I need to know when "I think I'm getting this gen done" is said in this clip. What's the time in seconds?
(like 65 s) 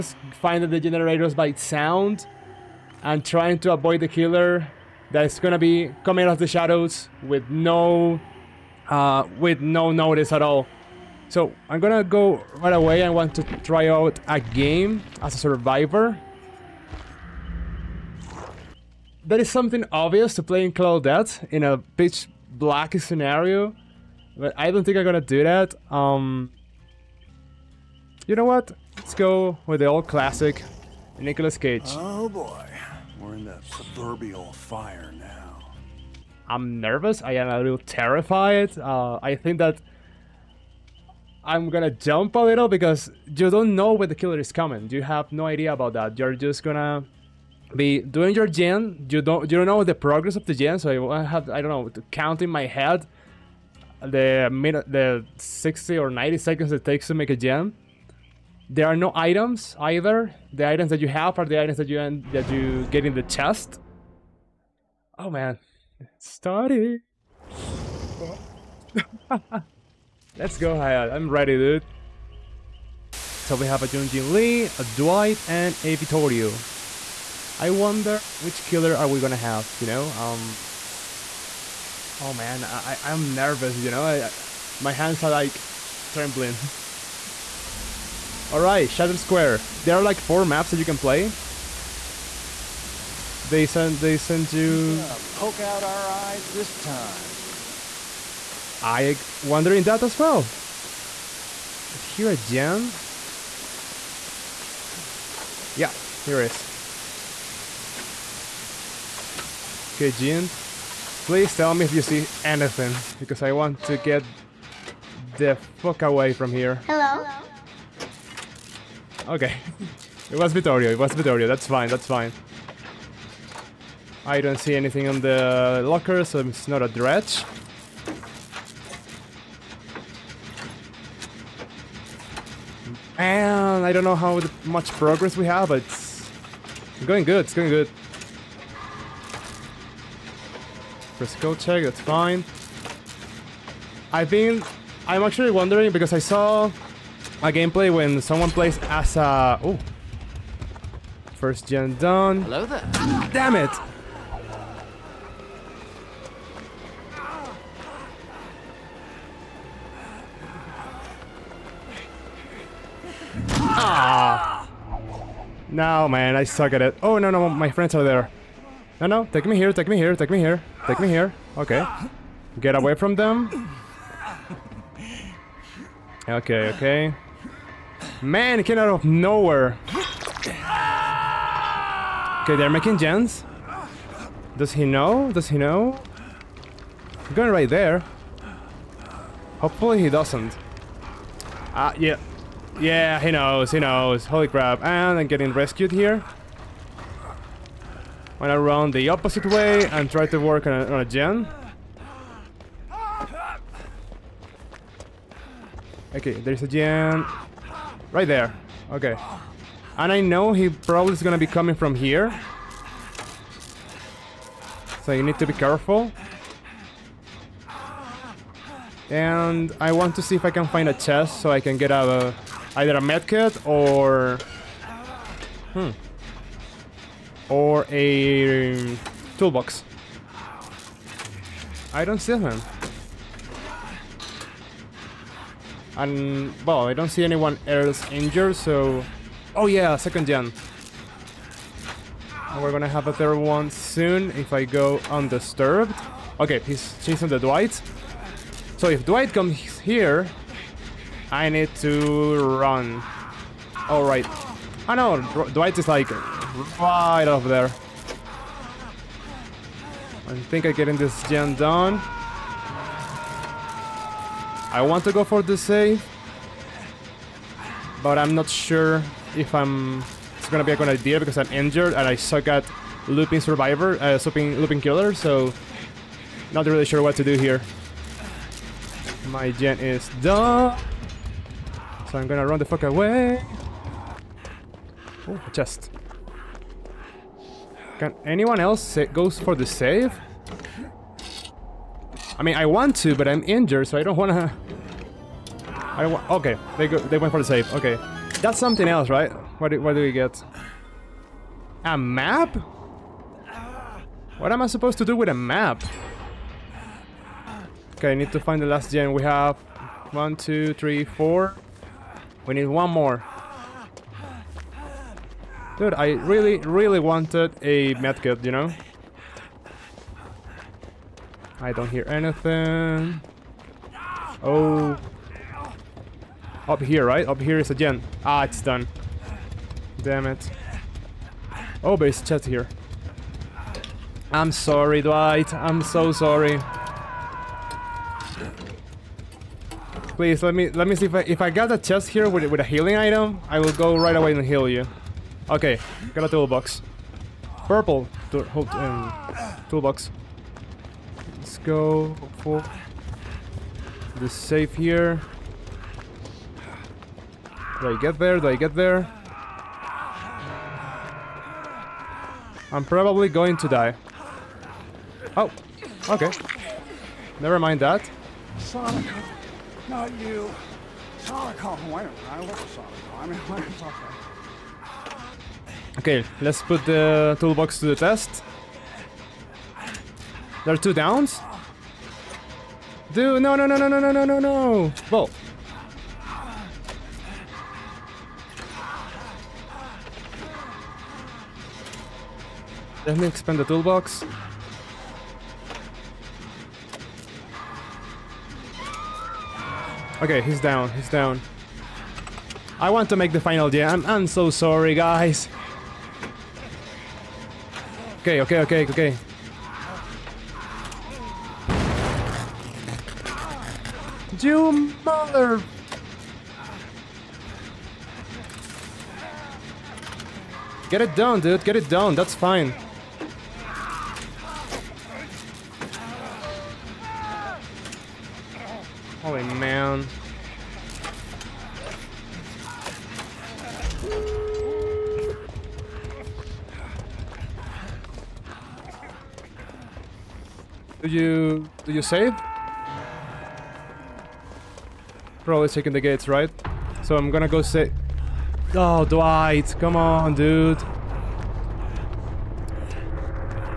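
260 s.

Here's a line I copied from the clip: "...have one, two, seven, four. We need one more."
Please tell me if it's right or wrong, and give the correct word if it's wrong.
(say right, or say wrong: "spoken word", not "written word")
wrong: "three", not "seven".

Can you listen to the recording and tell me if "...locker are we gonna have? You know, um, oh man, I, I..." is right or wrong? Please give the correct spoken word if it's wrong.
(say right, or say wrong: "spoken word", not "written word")
wrong: "killer", not "locker".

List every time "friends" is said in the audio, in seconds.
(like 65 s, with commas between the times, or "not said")
167 s.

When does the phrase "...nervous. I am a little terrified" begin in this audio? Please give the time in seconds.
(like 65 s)
36 s.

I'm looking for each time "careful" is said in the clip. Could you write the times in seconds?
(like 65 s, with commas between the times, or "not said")
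215 s.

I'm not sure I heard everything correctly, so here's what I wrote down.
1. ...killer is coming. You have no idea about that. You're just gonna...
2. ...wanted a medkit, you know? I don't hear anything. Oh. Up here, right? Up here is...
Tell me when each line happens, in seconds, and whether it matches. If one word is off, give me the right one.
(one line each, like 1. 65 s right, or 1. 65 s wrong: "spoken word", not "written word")
1. 44 s right
2. 317 s right.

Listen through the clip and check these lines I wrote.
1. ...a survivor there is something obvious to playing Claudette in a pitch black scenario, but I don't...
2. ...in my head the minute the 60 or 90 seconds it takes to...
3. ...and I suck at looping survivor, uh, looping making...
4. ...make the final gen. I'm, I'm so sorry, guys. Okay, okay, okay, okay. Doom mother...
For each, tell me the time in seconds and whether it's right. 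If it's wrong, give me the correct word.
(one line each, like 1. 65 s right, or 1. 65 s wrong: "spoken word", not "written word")
1. 15 s right
2. 52 s right
3. 271 s wrong: "looping", not "making"
4. 403 s right.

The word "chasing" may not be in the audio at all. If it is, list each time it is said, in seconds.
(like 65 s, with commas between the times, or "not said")
247 s.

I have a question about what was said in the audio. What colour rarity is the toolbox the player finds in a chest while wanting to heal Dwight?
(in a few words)
Purple.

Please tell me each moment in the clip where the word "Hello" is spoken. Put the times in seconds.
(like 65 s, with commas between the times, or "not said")
116 s, 152 s.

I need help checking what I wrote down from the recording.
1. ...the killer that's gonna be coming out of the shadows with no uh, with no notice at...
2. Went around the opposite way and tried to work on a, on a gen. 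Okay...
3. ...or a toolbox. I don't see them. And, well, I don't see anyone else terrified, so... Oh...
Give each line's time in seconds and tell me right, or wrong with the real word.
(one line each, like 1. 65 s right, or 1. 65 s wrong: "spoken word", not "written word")
1. 4 s right
2. 198 s right
3. 227 s wrong: "injured", not "terrified".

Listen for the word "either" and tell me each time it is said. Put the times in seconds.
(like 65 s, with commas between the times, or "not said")
59 s, 222 s.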